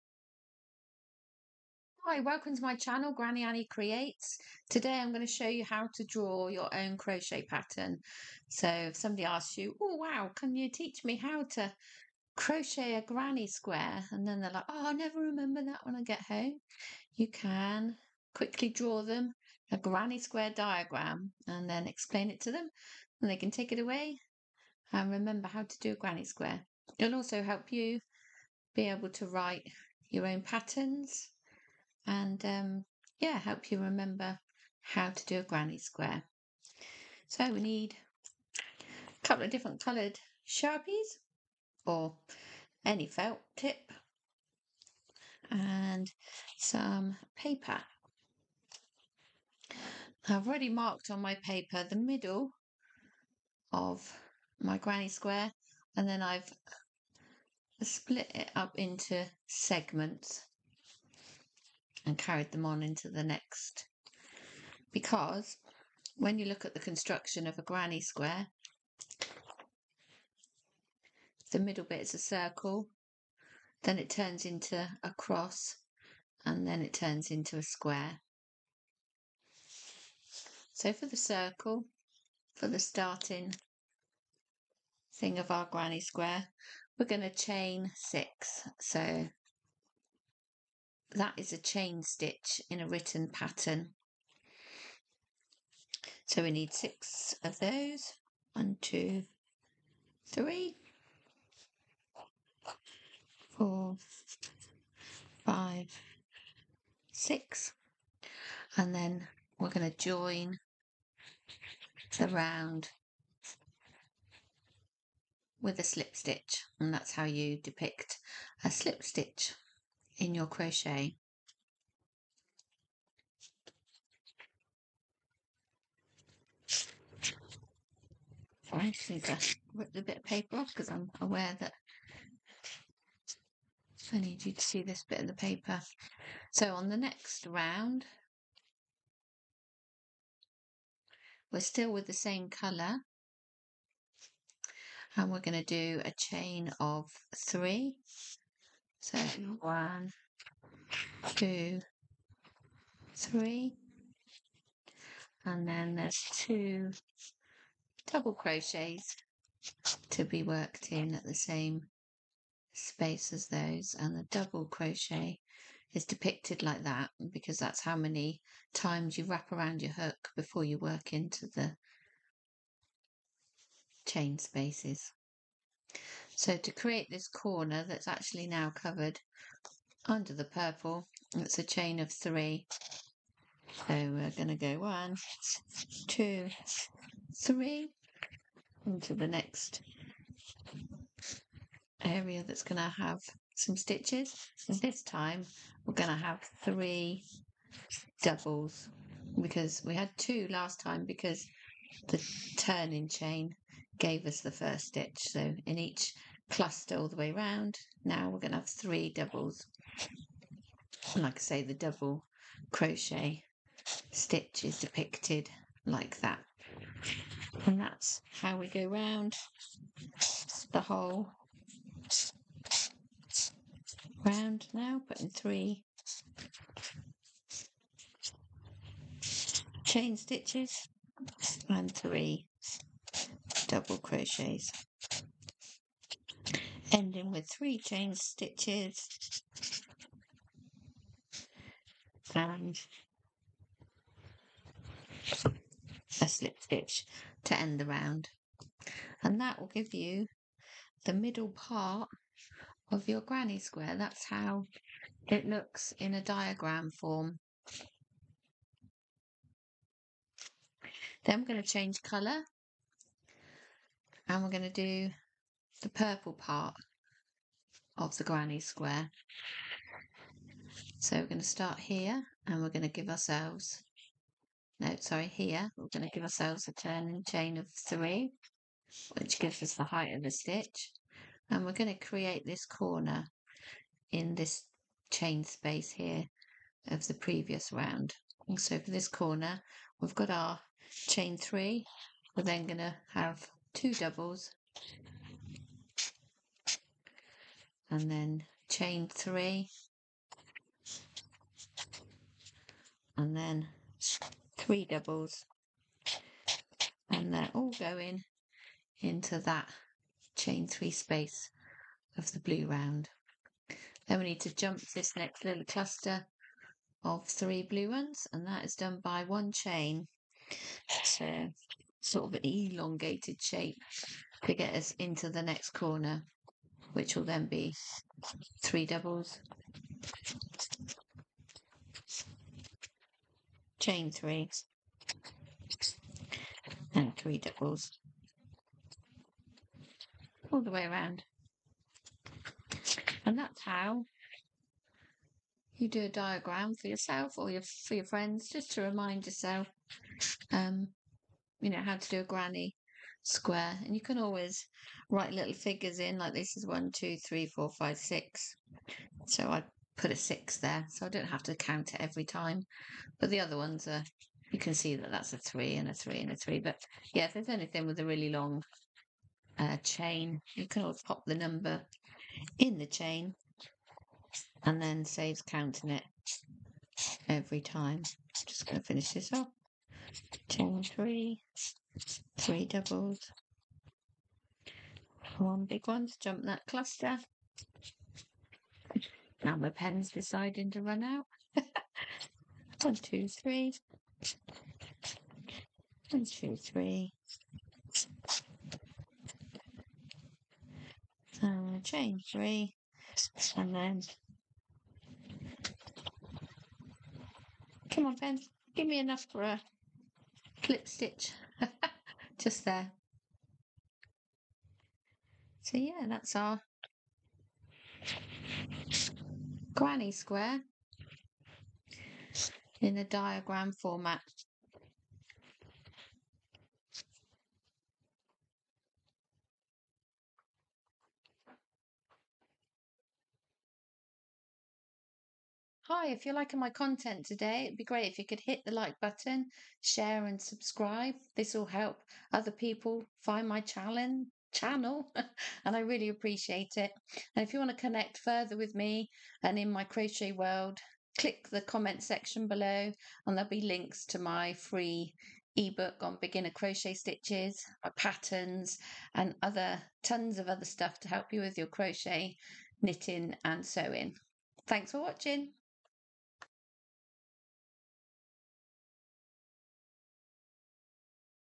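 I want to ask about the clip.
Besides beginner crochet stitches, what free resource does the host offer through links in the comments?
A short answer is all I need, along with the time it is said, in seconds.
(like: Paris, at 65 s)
ebook, at 455 s.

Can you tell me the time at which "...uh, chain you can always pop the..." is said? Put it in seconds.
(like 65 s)
369 s.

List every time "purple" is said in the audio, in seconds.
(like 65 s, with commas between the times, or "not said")
180 s, 265 s.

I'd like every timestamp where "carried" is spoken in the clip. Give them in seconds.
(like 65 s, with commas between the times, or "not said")
62 s.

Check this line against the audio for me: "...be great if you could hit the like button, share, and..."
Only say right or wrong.
right.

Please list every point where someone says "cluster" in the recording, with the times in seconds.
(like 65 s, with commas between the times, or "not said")
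206 s, 315 s, 386 s.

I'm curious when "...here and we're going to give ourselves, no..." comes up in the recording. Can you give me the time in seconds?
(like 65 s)
271 s.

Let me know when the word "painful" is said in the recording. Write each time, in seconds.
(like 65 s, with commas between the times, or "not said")
not said.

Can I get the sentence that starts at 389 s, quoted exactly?
Now my pen's deciding to run out.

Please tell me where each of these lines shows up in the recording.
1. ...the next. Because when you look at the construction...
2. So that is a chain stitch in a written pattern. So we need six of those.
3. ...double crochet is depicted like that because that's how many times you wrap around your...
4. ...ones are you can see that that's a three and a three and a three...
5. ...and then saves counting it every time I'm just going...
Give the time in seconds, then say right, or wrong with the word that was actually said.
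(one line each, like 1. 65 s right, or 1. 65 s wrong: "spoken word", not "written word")
1. 63 s right
2. 88 s right
3. 164 s right
4. 363 s right
5. 374 s right.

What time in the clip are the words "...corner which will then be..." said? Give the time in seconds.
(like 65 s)
325 s.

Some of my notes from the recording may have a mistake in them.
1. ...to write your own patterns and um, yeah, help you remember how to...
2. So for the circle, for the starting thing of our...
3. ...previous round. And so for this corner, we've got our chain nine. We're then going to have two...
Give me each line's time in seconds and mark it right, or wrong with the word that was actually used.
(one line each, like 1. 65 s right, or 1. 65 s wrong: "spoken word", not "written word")
1. 29 s right
2. 80 s right
3. 287 s wrong: "three", not "nine".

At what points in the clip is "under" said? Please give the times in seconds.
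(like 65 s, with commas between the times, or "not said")
180 s.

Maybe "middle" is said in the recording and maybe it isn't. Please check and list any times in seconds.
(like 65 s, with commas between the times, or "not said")
51 s, 71 s, 251 s.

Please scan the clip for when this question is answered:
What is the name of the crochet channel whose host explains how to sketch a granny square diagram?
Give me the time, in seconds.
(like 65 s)
3 s.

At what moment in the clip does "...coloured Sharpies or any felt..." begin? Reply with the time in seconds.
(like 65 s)
39 s.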